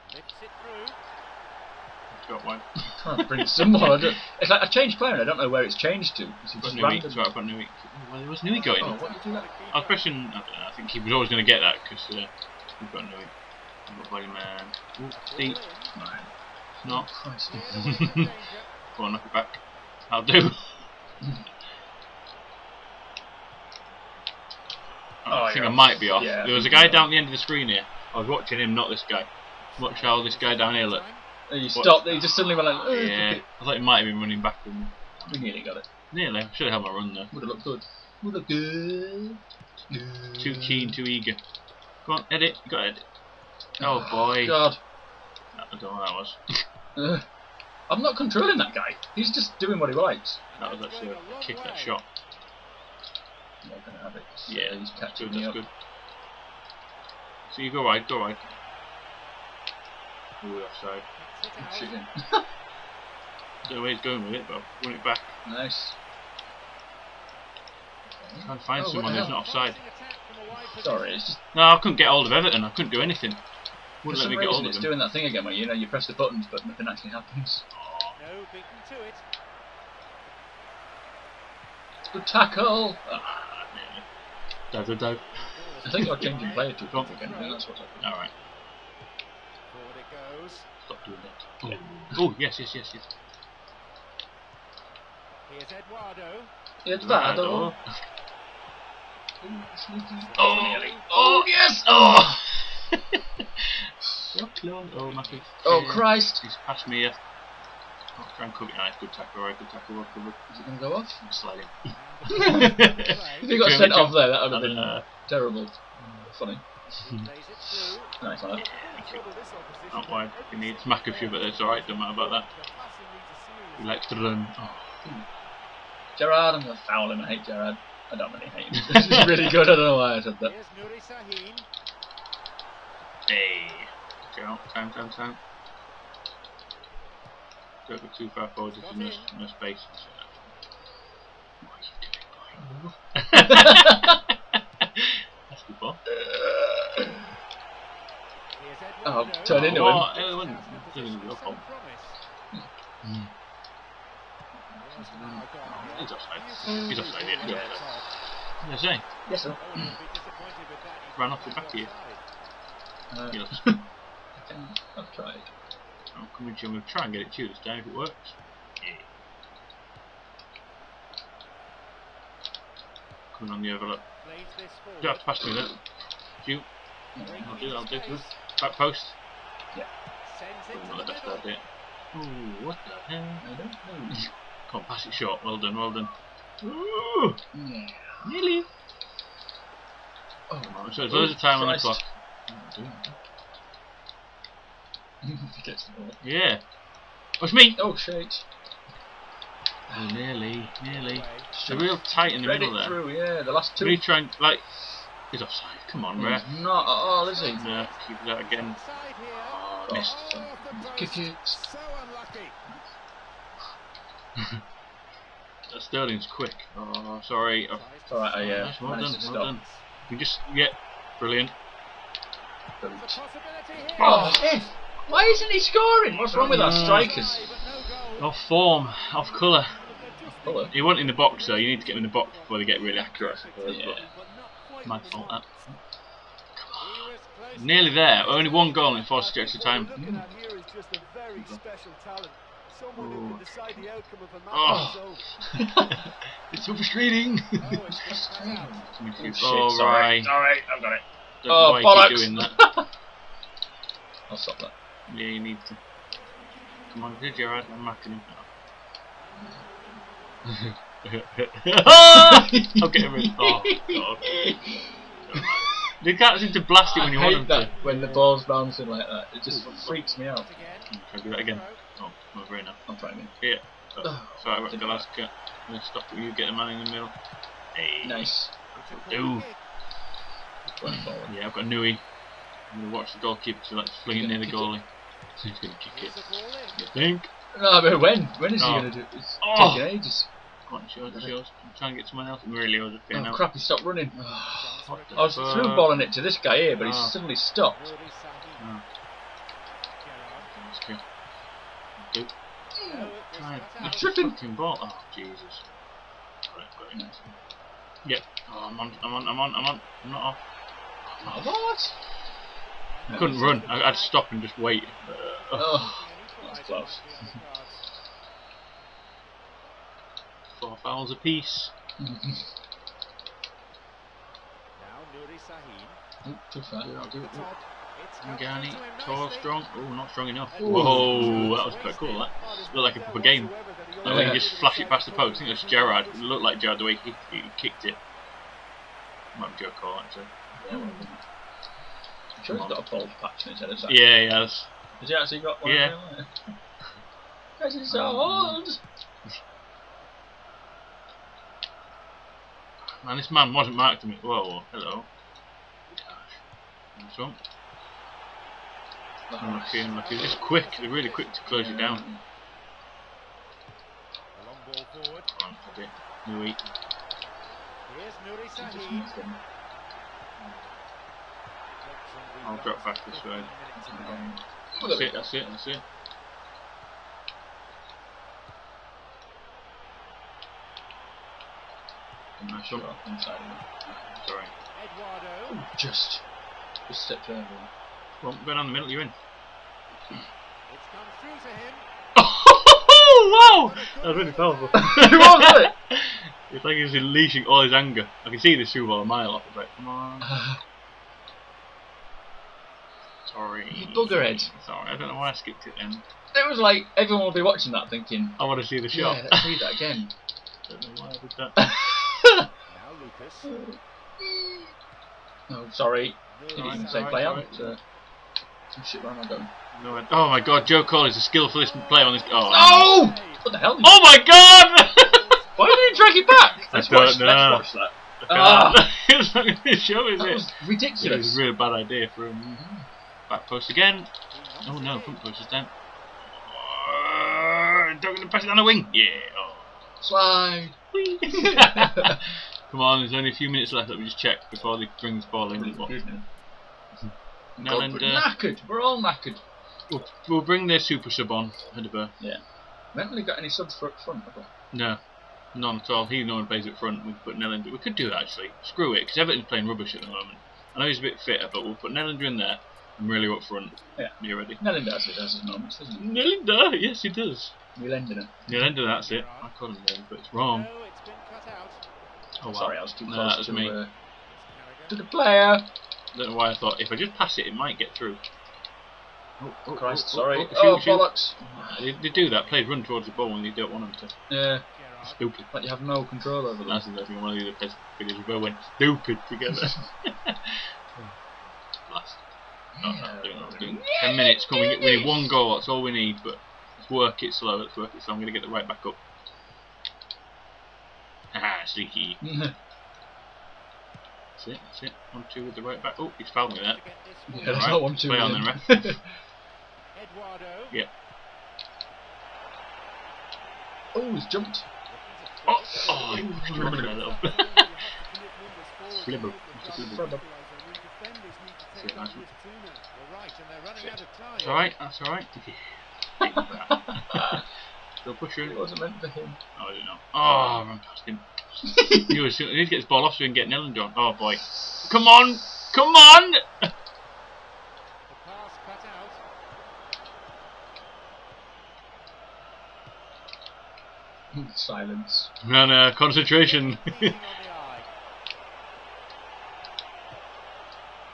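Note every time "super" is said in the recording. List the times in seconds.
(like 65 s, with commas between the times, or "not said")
398 s, 450 s.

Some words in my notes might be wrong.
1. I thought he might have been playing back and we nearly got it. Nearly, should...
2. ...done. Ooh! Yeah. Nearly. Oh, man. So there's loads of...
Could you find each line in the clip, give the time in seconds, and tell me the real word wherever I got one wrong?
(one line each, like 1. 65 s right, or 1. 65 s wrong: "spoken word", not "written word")
1. 33 s wrong: "running", not "playing"
2. 185 s right.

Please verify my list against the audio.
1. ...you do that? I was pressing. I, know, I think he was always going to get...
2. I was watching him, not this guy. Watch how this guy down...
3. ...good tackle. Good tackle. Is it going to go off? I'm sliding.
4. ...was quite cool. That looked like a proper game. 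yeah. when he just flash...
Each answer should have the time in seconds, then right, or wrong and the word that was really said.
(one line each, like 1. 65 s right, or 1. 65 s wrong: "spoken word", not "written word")
1. 9 s right
2. 28 s right
3. 109 s right
4. 331 s right.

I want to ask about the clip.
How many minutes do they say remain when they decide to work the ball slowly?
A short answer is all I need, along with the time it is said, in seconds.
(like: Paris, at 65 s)
10, at 494 s.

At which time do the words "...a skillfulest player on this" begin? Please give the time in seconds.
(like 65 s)
421 s.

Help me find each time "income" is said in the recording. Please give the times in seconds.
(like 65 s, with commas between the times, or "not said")
not said.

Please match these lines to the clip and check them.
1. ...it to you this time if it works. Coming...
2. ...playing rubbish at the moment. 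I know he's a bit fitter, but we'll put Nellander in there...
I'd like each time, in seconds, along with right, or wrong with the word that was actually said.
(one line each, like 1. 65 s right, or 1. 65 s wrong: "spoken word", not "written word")
1. 167 s right
2. 459 s right.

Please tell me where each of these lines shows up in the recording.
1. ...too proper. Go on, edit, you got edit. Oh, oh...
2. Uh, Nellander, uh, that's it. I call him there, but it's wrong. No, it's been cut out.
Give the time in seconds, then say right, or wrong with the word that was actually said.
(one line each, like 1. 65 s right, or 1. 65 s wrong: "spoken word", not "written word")
1. 40 s wrong: "eager", not "proper"
2. 468 s right.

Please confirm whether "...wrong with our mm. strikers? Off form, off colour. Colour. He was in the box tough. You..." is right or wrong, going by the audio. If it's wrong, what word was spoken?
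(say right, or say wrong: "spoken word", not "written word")
wrong: "though", not "tough".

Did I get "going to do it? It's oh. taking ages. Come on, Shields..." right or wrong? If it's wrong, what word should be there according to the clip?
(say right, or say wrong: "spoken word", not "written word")
right.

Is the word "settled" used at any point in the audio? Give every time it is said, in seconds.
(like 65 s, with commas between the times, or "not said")
not said.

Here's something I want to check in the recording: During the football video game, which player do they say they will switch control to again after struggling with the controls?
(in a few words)
Bronf.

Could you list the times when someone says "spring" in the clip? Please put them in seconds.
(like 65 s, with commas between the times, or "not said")
not said.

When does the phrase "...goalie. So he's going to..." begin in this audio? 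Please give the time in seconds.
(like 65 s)
284 s.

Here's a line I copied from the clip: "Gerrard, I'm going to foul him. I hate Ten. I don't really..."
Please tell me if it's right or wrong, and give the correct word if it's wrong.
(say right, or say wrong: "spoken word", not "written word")
wrong: "Gerrard", not "Ten".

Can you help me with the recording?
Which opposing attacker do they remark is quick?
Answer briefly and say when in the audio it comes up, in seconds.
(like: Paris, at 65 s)
Sterling, at 215 s.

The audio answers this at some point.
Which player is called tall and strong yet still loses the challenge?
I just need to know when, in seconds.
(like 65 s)
328 s.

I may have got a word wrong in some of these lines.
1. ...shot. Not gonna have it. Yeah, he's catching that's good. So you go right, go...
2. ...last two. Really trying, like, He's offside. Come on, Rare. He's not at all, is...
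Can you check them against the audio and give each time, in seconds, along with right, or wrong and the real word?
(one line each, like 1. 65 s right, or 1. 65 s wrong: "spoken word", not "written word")
1. 51 s right
2. 203 s right.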